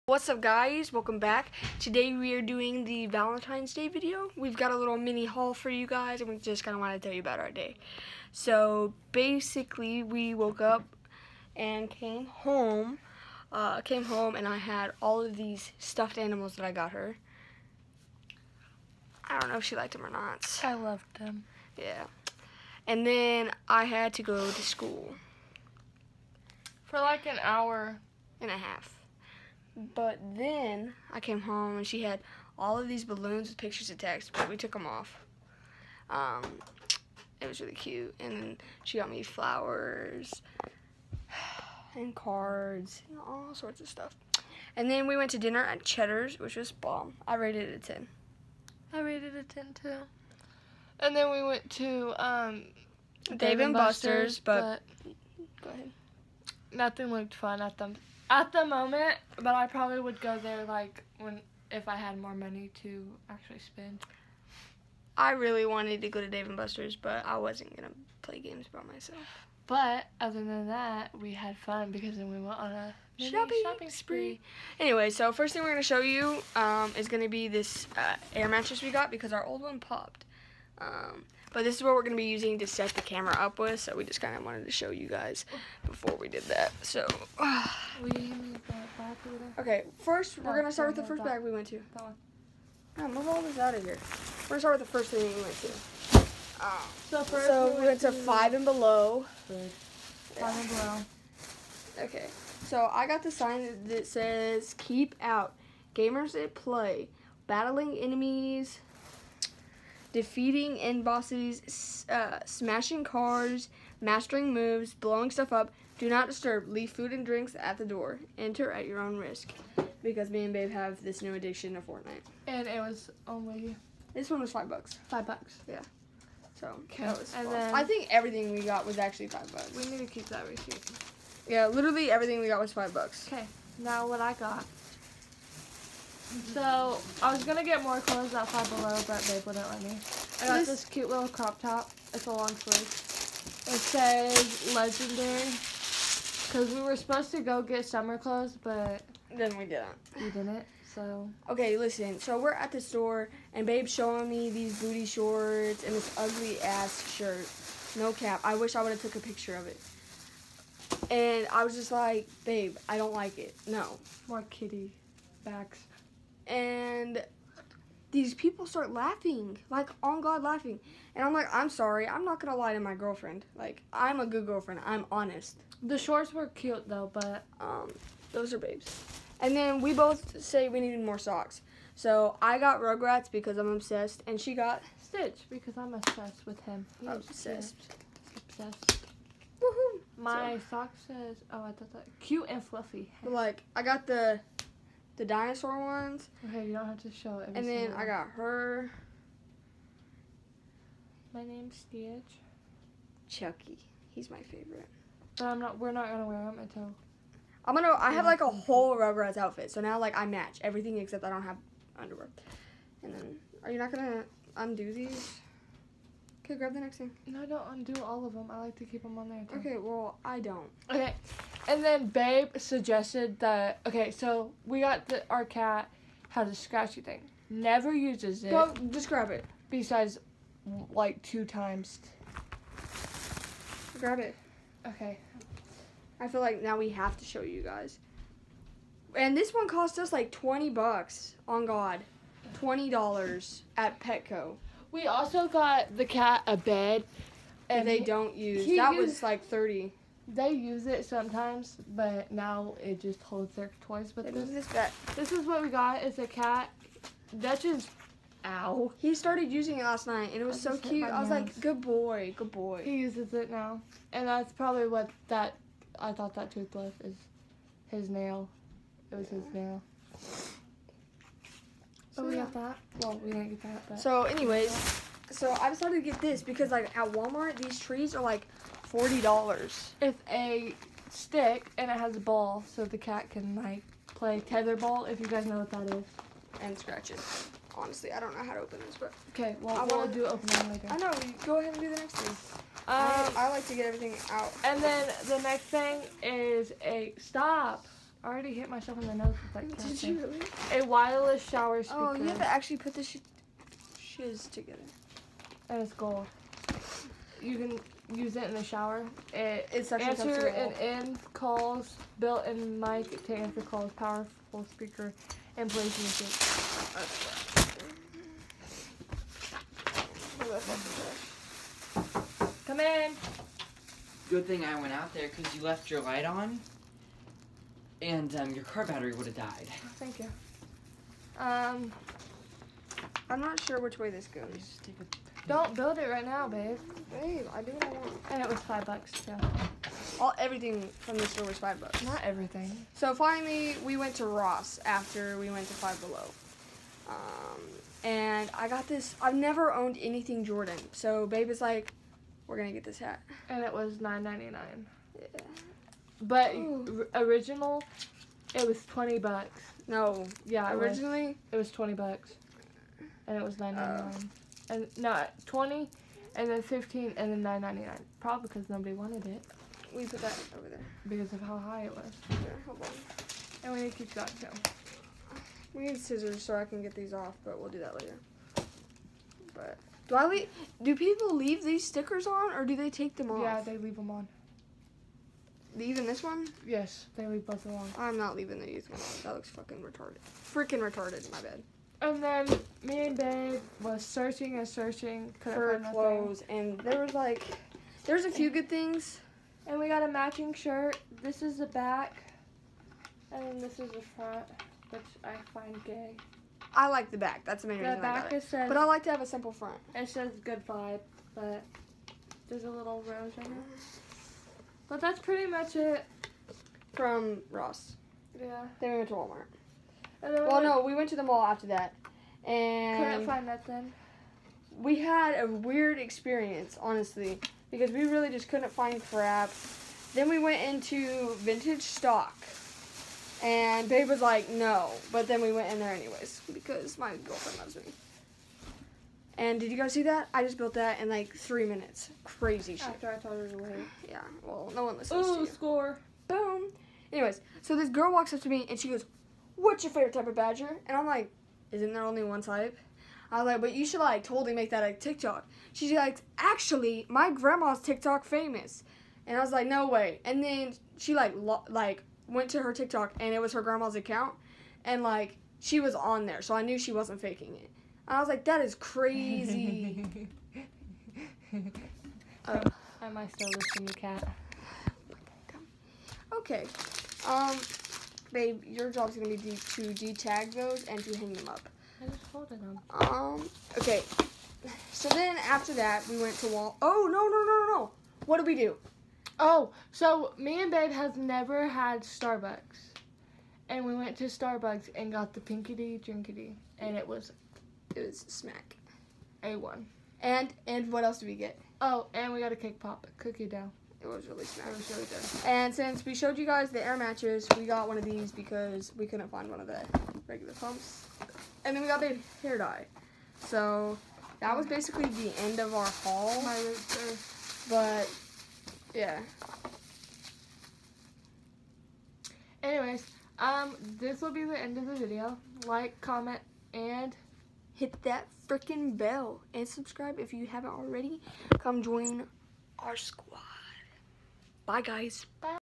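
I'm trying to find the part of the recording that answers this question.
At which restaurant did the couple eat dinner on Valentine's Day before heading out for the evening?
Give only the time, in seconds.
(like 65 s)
45 s.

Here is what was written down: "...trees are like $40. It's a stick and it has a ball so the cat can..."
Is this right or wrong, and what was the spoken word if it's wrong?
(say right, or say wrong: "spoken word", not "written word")
right.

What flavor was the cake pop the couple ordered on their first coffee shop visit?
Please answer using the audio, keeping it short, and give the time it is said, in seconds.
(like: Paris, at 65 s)
cookie dough, at 503 s.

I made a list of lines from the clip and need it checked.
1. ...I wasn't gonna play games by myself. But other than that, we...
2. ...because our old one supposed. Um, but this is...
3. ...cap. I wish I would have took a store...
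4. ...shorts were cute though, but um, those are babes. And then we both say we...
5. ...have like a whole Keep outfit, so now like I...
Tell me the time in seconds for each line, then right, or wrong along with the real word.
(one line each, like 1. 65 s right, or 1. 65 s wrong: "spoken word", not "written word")
1. 67 s right
2. 79 s wrong: "popped", not "supposed"
3. 158 s wrong: "picture", not "store"
4. 175 s right
5. 208 s wrong: "Rugrats", not "Keep".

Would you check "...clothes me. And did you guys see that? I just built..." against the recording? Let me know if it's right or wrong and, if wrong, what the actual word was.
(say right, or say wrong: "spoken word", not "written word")
wrong: "loves", not "clothes".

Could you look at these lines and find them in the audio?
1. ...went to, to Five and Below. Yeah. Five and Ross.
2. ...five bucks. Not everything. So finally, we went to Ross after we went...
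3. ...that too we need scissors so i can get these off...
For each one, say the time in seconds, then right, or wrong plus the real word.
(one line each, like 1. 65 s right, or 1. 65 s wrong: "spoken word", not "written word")
1. 97 s wrong: "Below", not "Ross"
2. 341 s right
3. 374 s right.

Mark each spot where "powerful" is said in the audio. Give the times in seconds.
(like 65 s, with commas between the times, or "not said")
313 s.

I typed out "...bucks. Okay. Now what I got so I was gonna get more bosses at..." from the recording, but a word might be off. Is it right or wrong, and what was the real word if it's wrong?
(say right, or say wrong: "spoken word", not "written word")
wrong: "clothes", not "bosses".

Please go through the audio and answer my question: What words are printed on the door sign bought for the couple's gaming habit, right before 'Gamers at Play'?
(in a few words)
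Keep Out.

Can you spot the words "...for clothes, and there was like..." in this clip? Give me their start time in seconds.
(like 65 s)
395 s.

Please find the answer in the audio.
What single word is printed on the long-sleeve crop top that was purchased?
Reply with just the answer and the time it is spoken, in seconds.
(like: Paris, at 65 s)
legendary, at 144 s.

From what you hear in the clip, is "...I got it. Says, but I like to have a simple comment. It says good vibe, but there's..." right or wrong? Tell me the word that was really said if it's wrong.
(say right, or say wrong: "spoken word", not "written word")
wrong: "front", not "comment".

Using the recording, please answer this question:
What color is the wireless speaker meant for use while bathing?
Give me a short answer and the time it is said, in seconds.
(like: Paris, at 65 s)
gold, at 305 s.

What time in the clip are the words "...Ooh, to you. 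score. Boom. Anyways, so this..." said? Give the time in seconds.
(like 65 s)
445 s.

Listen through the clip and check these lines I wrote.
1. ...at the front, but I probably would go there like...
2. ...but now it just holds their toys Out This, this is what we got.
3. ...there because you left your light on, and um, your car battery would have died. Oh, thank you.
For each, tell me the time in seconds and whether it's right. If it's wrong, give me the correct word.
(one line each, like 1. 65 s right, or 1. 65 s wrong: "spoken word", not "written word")
1. 58 s wrong: "moment", not "front"
2. 251 s wrong: "But", not "Out"
3. 325 s right.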